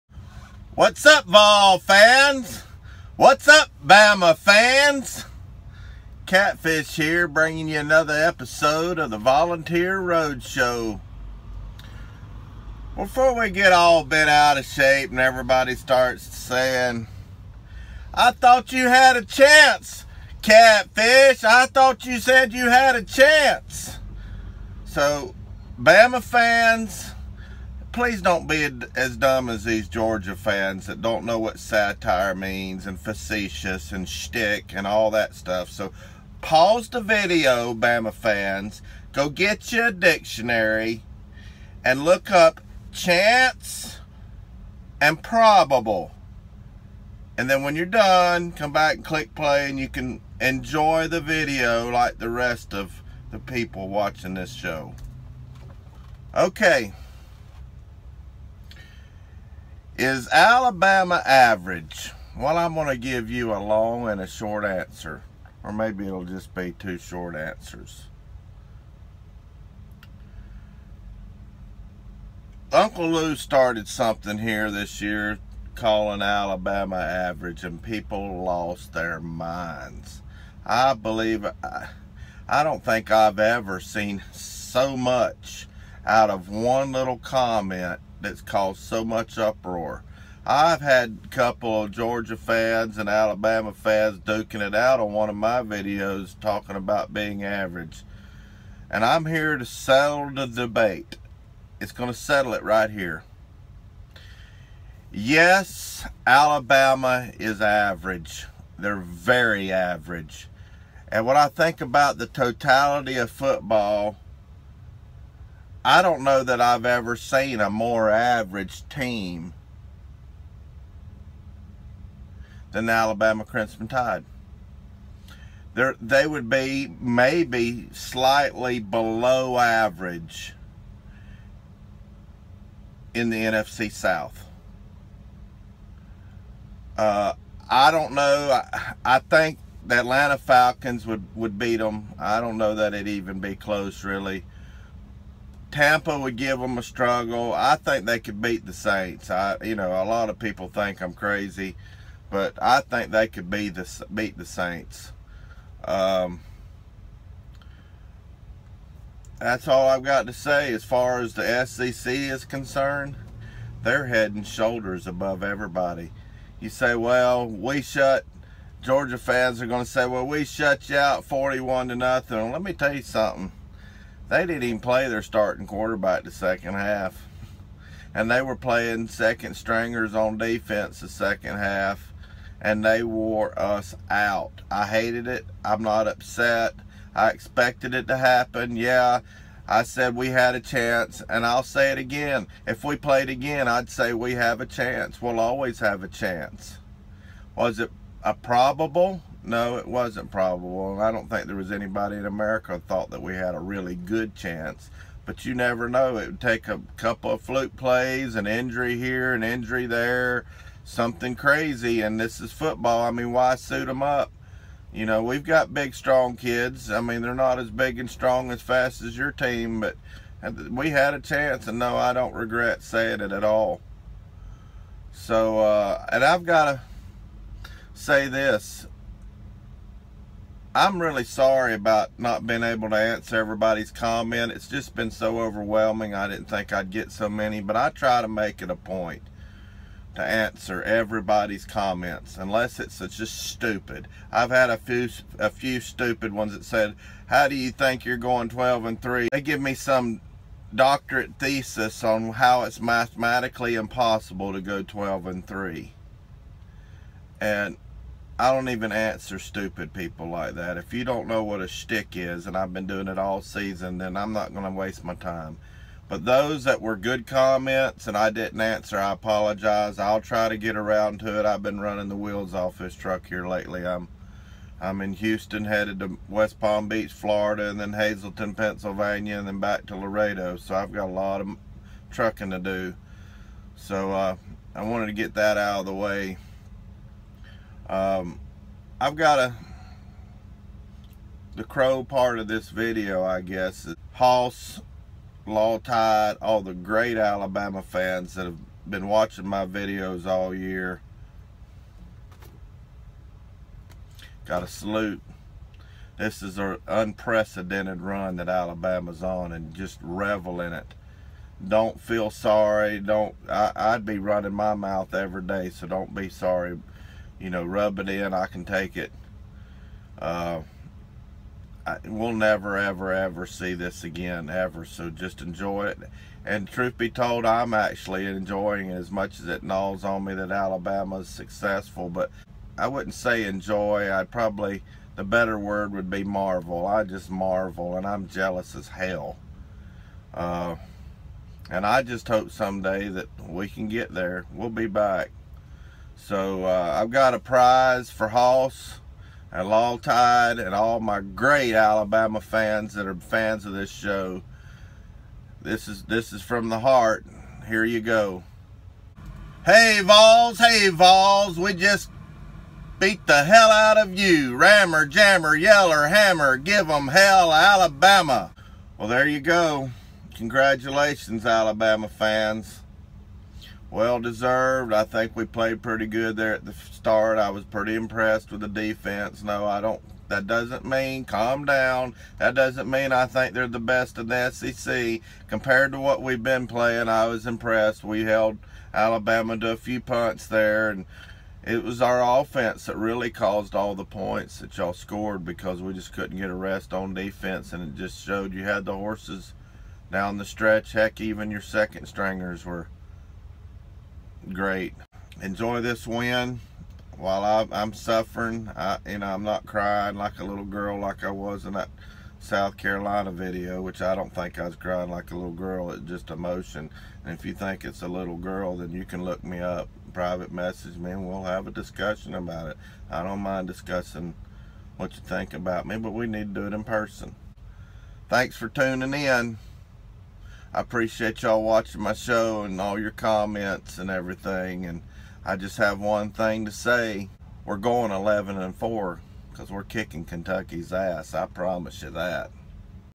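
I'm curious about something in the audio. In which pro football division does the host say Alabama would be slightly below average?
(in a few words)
NFC South.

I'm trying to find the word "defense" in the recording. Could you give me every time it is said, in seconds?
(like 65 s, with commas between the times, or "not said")
180 s, 378 s, 397 s.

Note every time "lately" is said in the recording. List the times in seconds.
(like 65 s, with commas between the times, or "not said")
273 s.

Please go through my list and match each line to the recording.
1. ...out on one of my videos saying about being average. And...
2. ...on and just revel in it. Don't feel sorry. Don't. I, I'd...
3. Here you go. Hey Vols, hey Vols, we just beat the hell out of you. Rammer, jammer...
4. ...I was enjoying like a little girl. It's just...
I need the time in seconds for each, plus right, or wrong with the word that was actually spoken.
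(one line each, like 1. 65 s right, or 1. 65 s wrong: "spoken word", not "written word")
1. 94 s wrong: "talking", not "saying"
2. 309 s right
3. 357 s right
4. 414 s wrong: "crying", not "enjoying".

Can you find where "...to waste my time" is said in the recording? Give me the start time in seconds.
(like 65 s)
264 s.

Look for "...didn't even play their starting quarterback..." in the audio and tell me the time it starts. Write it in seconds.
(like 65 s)
174 s.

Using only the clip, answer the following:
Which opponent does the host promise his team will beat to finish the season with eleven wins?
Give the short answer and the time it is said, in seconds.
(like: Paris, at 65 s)
Kentucky, at 440 s.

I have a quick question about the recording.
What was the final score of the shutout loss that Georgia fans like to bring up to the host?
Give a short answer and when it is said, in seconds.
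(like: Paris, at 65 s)
41 to 0, at 171 s.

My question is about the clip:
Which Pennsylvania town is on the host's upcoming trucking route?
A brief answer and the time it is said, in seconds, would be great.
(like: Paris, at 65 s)
Hazleton, at 277 s.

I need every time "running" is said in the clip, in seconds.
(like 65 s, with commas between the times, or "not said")
271 s, 314 s.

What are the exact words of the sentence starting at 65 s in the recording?
Or maybe it'll just be two short answers.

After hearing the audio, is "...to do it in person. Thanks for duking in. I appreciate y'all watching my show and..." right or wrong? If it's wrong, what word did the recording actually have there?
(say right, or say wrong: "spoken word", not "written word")
wrong: "tuning", not "duking".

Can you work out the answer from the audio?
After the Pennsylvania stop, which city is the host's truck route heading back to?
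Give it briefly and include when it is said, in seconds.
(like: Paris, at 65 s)
Laredo, at 279 s.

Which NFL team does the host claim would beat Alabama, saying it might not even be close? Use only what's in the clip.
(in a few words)
Atlanta Falcons.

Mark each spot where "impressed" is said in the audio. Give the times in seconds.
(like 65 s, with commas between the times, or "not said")
377 s, 387 s.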